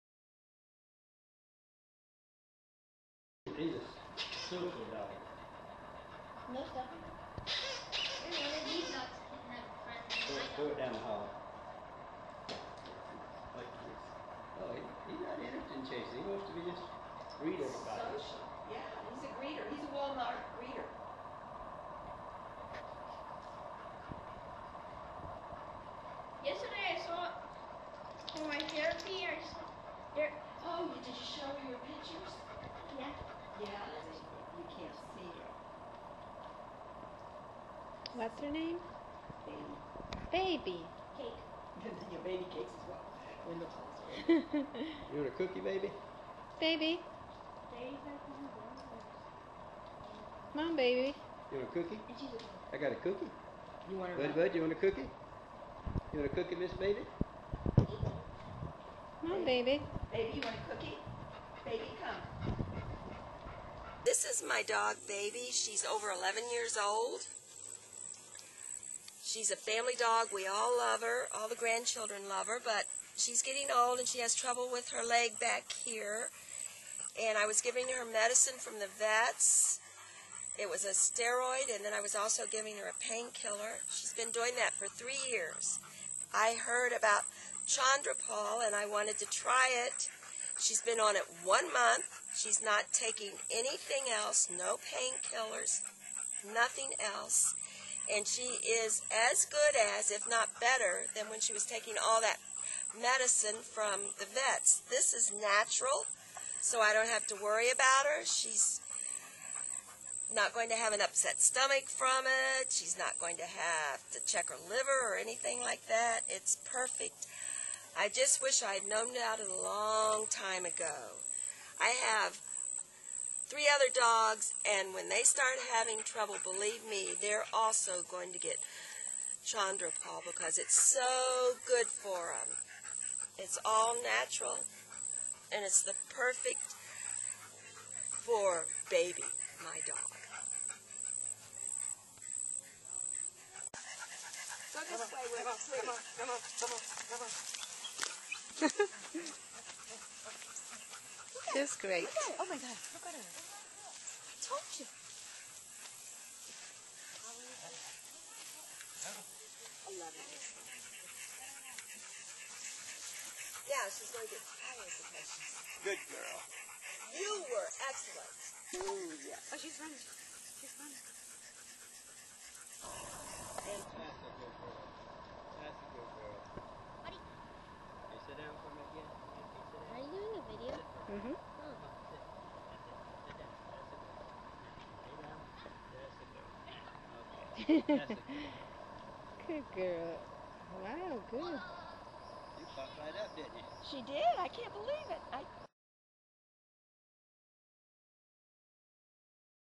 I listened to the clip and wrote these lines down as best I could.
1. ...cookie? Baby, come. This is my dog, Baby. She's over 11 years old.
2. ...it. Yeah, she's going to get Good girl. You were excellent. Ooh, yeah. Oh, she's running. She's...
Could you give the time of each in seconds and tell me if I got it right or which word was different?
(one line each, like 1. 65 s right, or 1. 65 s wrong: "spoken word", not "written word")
1. 60 s right
2. 160 s right.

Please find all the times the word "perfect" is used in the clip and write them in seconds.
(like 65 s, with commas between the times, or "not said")
116 s, 136 s.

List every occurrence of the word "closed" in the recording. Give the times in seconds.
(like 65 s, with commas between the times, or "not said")
43 s.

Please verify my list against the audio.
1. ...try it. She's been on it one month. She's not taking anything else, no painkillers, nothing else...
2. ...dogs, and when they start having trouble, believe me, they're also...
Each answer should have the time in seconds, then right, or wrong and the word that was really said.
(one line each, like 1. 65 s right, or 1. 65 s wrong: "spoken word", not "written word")
1. 89 s right
2. 123 s right.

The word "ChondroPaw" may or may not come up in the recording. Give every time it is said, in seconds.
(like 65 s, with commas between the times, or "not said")
87 s, 129 s.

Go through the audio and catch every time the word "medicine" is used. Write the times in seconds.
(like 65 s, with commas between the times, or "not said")
78 s, 102 s.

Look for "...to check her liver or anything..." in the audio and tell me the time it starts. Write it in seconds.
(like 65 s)
114 s.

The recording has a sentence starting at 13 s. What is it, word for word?
Like Oh, he, he's not interested in chasing.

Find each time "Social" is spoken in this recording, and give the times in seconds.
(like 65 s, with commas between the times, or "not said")
17 s.